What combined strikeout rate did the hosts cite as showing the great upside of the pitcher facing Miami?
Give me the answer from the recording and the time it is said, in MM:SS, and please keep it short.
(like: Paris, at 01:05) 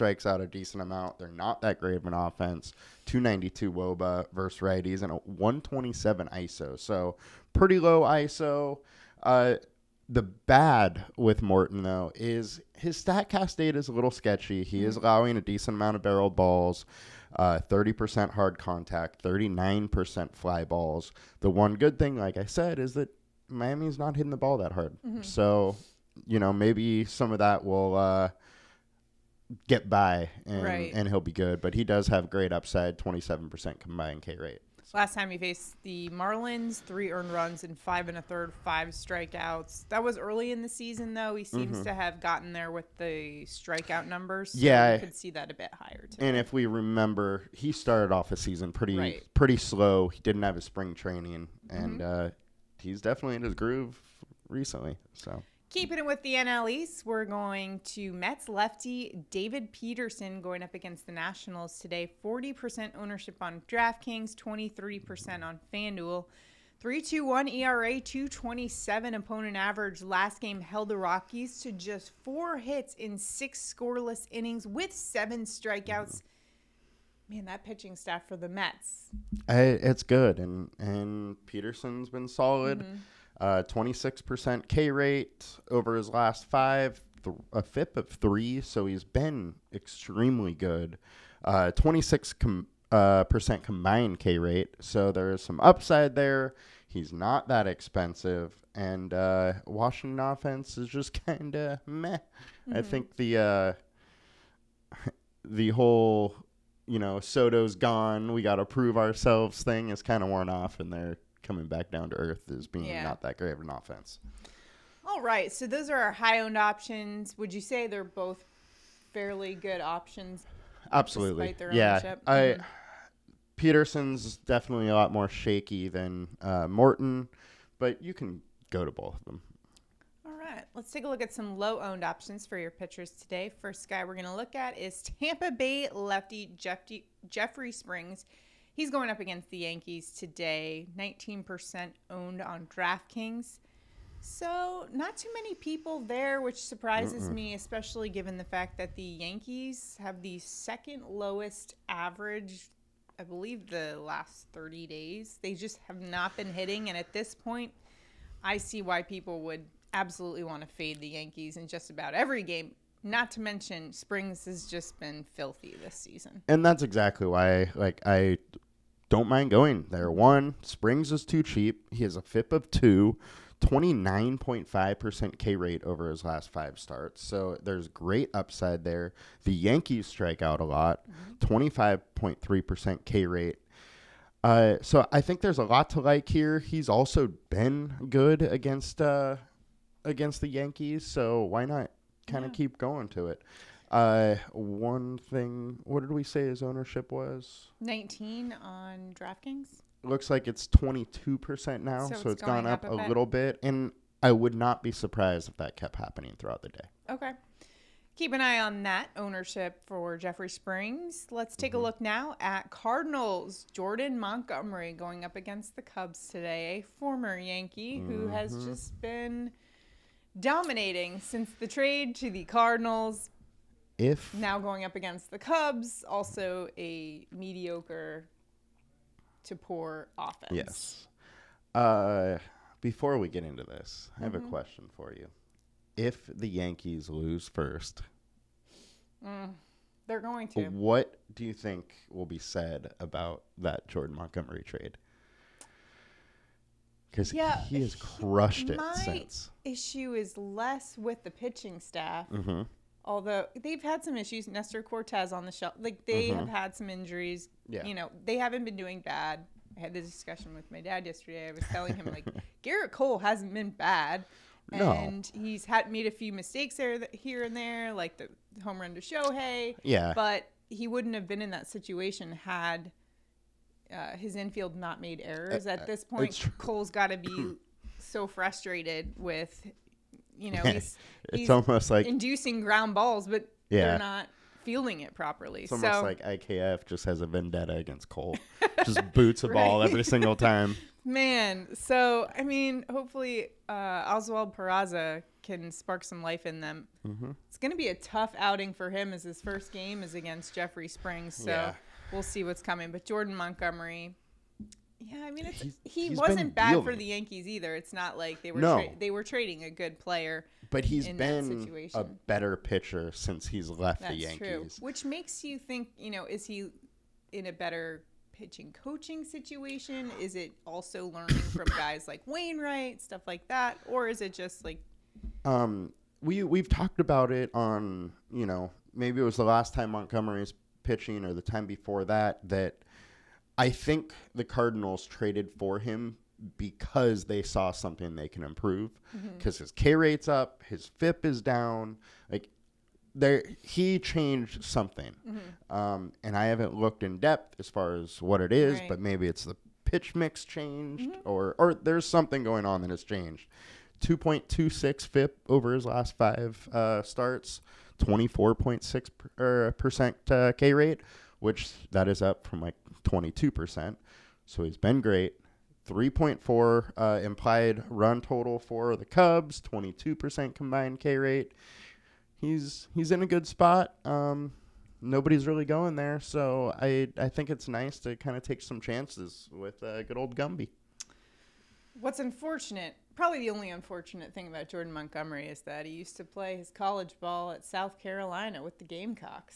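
27%, at 00:32.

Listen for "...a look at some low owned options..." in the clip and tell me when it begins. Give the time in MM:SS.
02:11.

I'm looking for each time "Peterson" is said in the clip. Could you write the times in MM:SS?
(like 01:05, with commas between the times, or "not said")
00:59, 01:21, 02:03.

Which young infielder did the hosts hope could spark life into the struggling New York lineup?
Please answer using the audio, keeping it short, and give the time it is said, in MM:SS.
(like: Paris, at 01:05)
Oswald Peraza, at 04:54.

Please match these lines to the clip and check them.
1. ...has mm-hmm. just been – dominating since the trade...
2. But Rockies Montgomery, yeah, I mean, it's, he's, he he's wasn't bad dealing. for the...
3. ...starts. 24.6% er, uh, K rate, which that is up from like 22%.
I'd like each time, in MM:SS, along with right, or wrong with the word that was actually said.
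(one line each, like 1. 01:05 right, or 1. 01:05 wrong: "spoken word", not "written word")
1. 03:38 right
2. 05:02 wrong: "Jordan", not "Rockies"
3. 05:57 right.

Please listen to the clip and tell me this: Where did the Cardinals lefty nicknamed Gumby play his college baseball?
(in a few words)
South Carolina.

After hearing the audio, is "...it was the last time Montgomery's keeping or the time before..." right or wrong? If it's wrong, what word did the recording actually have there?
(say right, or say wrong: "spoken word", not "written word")
wrong: "pitching", not "keeping".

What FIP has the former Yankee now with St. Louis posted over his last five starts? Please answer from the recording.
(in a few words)
2.26.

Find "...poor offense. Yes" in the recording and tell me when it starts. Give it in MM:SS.
03:49.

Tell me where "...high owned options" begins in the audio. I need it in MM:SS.
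01:56.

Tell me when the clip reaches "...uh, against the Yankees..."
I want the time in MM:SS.
03:08.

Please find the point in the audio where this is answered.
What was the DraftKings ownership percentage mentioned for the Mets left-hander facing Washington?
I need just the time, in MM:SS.
01:02.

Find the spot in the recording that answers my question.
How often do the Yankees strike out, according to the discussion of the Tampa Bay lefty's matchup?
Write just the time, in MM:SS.
03:01.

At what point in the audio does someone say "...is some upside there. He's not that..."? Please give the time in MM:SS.
01:35.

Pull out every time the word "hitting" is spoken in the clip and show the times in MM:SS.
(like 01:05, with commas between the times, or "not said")
00:24, 02:36.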